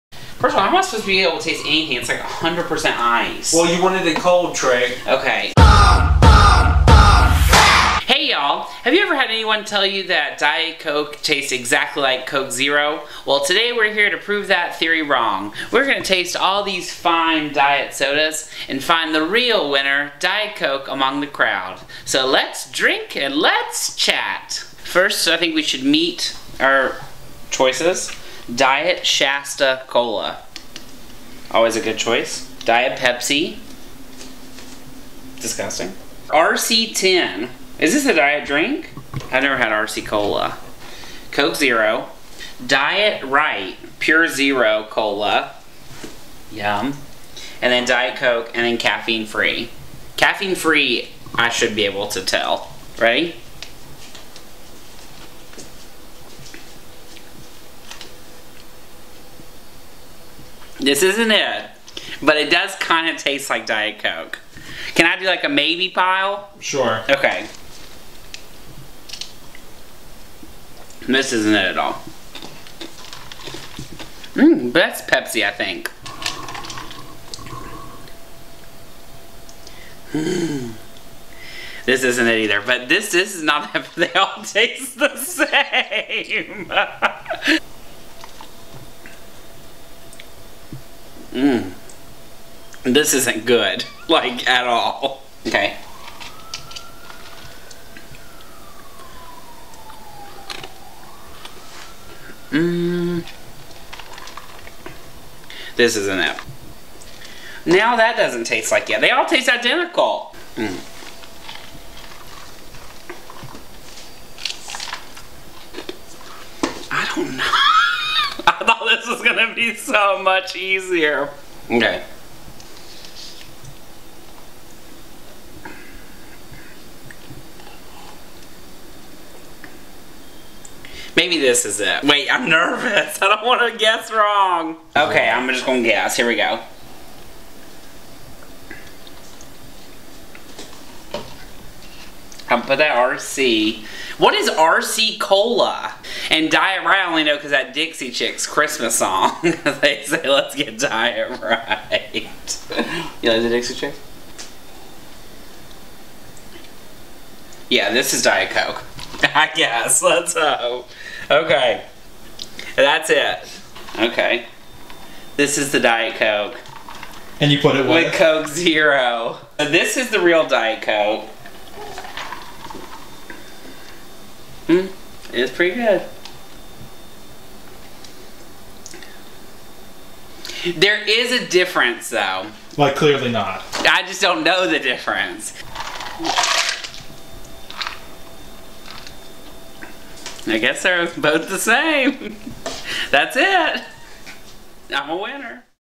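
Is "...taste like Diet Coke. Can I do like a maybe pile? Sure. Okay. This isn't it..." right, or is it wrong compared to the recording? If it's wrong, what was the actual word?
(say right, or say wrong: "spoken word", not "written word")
right.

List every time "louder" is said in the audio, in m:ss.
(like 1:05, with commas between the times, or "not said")
not said.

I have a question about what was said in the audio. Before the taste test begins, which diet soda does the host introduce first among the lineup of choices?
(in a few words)
Diet Shasta Cola.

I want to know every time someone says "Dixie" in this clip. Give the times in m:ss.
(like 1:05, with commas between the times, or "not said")
2:27, 2:33.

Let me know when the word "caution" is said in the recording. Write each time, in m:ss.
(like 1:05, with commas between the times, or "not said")
not said.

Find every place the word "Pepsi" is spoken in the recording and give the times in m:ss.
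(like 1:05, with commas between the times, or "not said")
0:32, 1:15.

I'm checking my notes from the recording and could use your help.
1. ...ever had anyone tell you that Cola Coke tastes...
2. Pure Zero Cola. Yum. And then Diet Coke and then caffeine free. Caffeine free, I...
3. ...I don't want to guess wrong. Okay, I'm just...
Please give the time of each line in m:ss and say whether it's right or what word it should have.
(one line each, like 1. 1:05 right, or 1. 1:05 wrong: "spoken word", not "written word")
1. 0:09 wrong: "Diet", not "Cola"
2. 0:43 right
3. 2:13 right.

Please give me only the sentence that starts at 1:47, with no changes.
Now that doesn't taste like it.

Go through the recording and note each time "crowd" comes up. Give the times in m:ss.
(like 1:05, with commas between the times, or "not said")
0:21.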